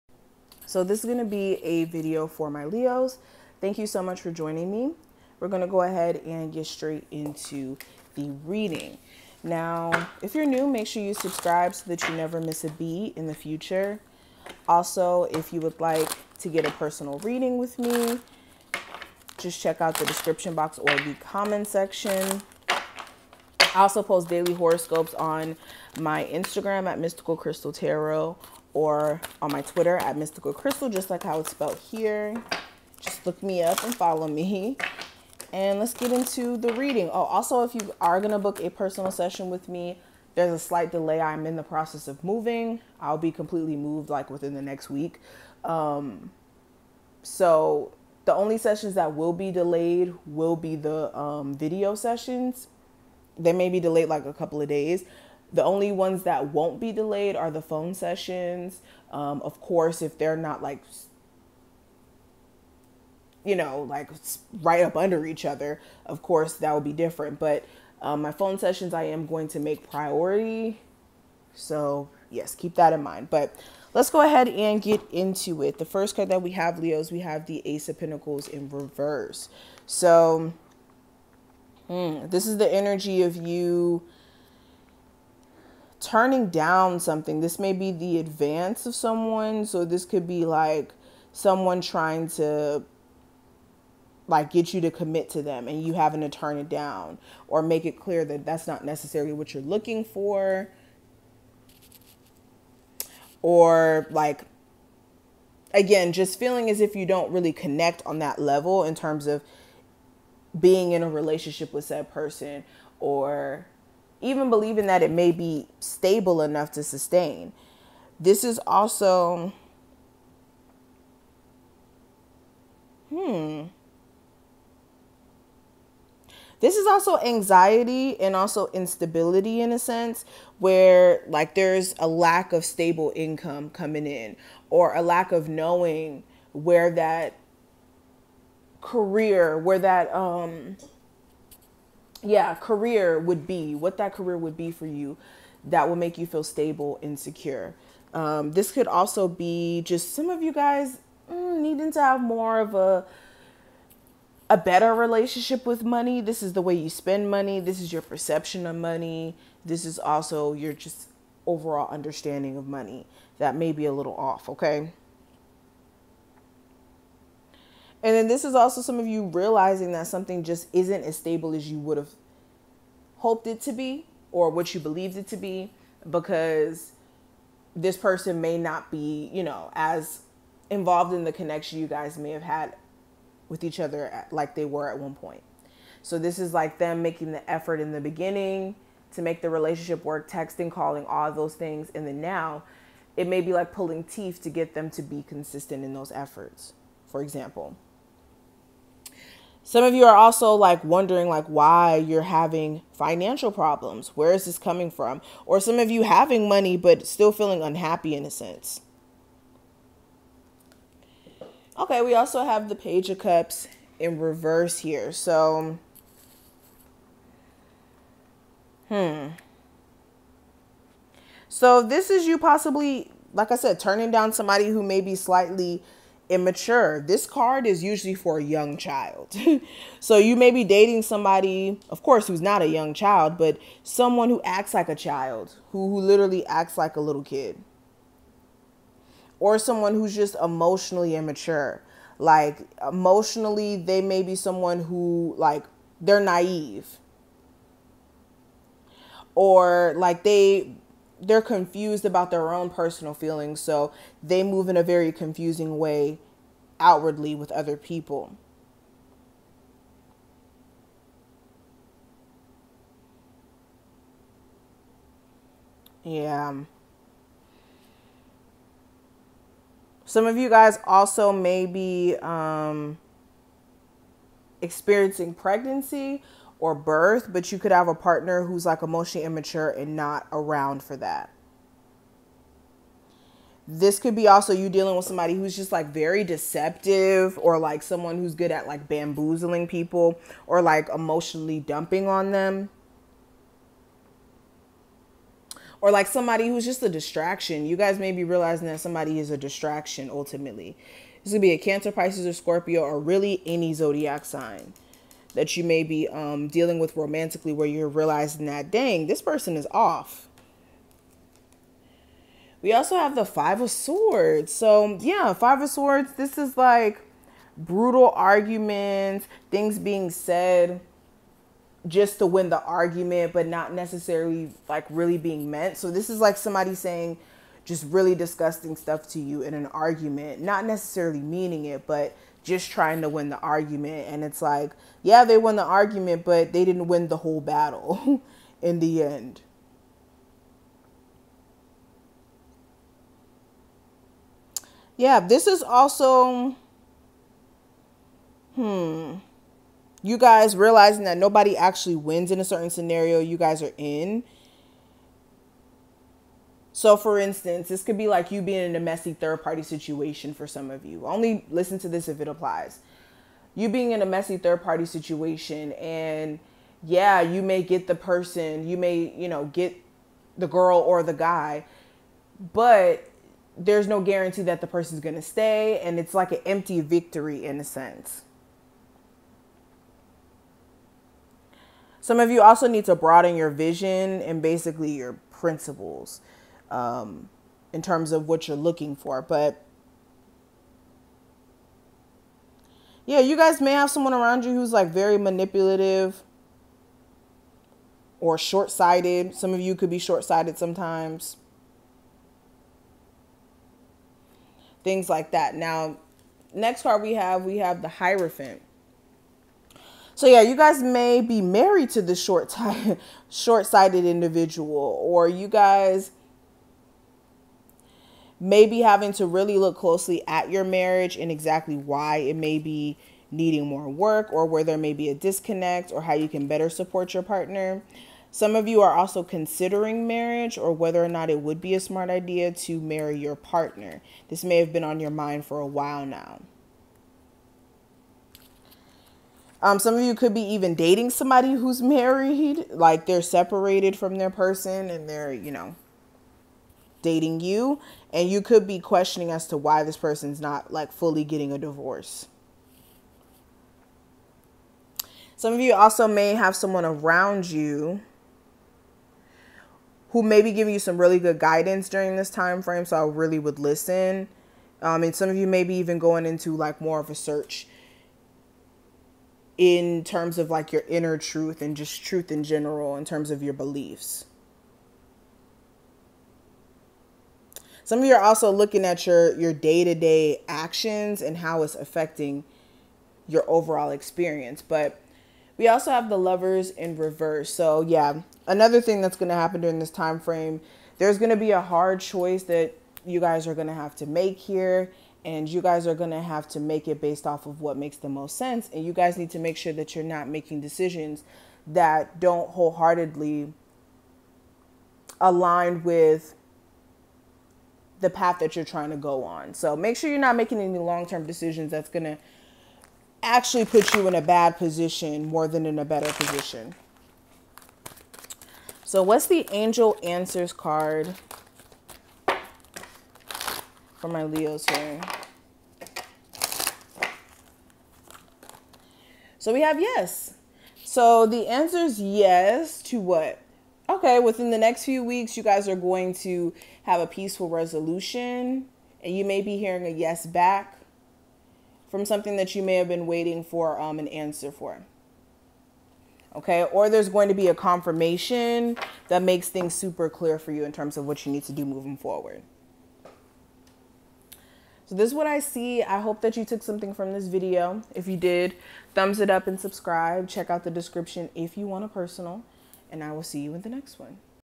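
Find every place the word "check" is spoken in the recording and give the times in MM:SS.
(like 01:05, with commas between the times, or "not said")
00:19, 09:20.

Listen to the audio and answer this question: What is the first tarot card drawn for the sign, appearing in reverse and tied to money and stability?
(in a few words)
Ace of Pentacles.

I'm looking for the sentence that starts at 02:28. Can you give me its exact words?
Um, this could also be just some of you guys mm, needing to have more of a a better relationship with money.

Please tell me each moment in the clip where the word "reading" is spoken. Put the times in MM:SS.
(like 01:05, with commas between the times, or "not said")
00:08, 00:17, 00:36.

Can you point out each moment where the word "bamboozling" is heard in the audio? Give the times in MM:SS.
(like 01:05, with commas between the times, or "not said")
04:48.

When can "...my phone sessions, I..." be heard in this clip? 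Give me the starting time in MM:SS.
01:08.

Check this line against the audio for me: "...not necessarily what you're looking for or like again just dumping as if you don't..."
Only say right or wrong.
wrong.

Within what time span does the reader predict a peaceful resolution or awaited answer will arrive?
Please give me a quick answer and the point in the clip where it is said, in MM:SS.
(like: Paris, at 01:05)
The next few weeks, at 08:54.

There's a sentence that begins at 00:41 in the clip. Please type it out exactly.
I'm in the process of moving.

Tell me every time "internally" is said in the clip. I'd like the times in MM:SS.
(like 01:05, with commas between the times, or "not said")
not said.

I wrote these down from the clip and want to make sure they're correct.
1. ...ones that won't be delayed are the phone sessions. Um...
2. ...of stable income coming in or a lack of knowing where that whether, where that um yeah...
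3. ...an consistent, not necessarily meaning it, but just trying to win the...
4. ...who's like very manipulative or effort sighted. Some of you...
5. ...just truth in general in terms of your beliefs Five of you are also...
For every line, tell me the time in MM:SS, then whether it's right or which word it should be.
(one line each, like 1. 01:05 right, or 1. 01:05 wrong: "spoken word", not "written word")
1. 00:55 right
2. 02:12 wrong: "career", not "whether"
3. 05:29 wrong: "argument", not "consistent"
4. 06:34 wrong: "short", not "effort"
5. 07:51 wrong: "Some", not "Five".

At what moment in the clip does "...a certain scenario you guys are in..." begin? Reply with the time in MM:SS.
05:52.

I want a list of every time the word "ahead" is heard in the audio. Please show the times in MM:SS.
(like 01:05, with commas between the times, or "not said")
00:05, 01:14.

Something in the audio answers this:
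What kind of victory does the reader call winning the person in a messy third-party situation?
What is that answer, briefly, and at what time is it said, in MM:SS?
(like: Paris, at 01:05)
An empty victory, at 06:16.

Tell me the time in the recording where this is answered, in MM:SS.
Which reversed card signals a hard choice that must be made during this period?
08:06.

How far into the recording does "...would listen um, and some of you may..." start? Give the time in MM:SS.
07:43.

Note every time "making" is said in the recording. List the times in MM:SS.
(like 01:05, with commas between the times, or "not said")
03:07, 08:20, 08:30.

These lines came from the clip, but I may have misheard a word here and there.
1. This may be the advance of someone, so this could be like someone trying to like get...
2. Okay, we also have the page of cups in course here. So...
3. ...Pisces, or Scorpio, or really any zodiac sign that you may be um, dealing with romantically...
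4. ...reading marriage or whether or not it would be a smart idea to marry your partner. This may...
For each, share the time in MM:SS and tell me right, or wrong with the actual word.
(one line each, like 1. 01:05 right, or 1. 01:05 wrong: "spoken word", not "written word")
1. 01:27 right
2. 03:31 wrong: "reverse", not "course"
3. 05:01 right
4. 07:09 wrong: "considering", not "reading".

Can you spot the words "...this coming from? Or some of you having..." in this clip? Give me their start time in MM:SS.
03:24.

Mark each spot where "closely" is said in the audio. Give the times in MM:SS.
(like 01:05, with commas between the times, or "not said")
06:59.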